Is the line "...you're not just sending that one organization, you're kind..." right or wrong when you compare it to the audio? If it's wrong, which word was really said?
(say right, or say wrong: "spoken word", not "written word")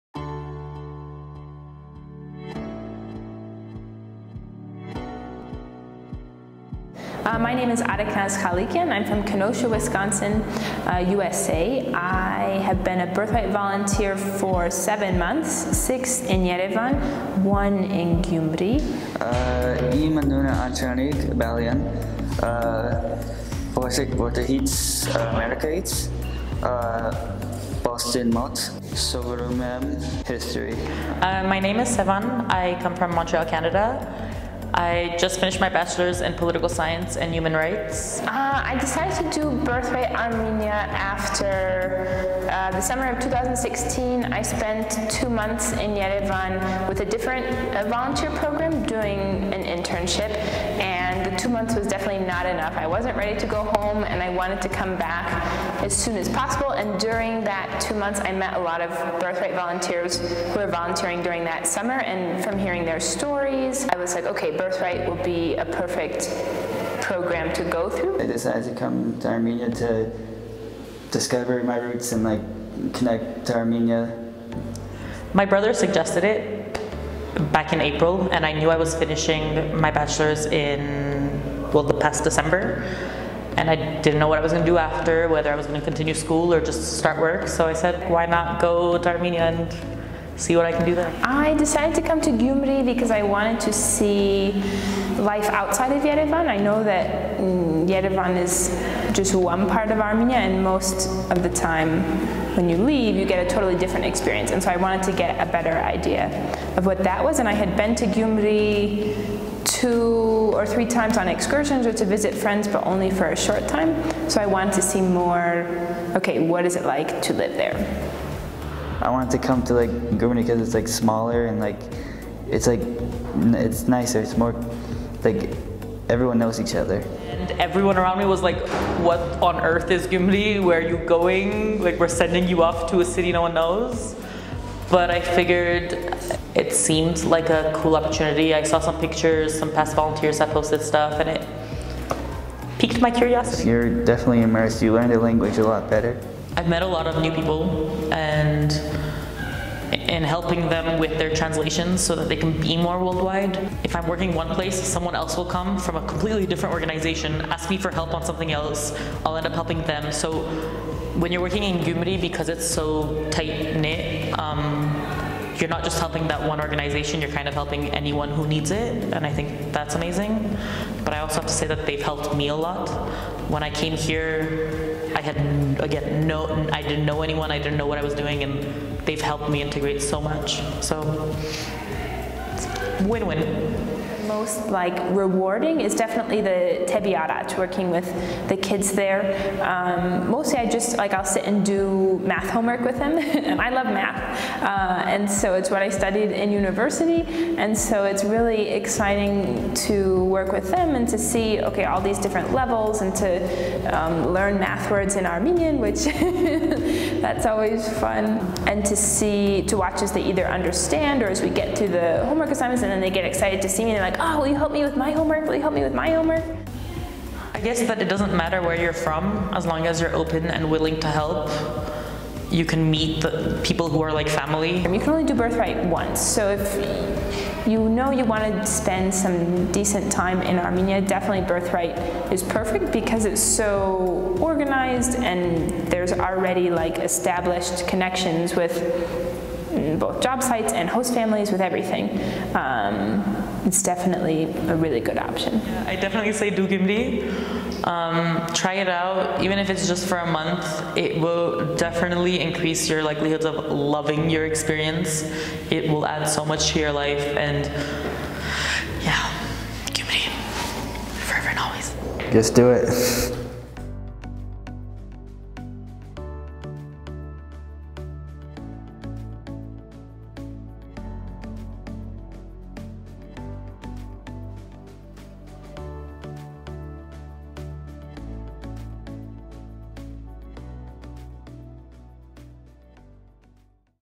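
wrong: "helping", not "sending".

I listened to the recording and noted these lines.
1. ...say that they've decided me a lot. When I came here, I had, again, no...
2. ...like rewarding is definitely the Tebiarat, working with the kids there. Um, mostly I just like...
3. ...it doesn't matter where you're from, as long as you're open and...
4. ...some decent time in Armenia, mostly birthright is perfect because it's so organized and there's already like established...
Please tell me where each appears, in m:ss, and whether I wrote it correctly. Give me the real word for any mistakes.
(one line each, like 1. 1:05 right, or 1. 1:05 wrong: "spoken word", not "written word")
1. 2:51 wrong: "helped", not "decided"
2. 3:04 right
3. 3:38 right
4. 3:49 wrong: "definitely", not "mostly".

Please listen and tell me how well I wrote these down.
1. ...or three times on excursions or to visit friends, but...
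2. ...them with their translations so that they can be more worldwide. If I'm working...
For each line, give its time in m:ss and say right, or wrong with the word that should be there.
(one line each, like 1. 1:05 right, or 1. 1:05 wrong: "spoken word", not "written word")
1. 1:50 right
2. 2:30 right.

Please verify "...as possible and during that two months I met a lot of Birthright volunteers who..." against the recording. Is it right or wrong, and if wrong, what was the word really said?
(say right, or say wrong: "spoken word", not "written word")
right.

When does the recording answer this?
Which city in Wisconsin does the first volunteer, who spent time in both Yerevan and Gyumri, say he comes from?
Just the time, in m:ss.
0:09.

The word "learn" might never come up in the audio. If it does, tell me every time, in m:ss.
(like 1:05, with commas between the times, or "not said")
2:24, 3:24.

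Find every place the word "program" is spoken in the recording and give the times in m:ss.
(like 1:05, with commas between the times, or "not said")
0:48, 1:07.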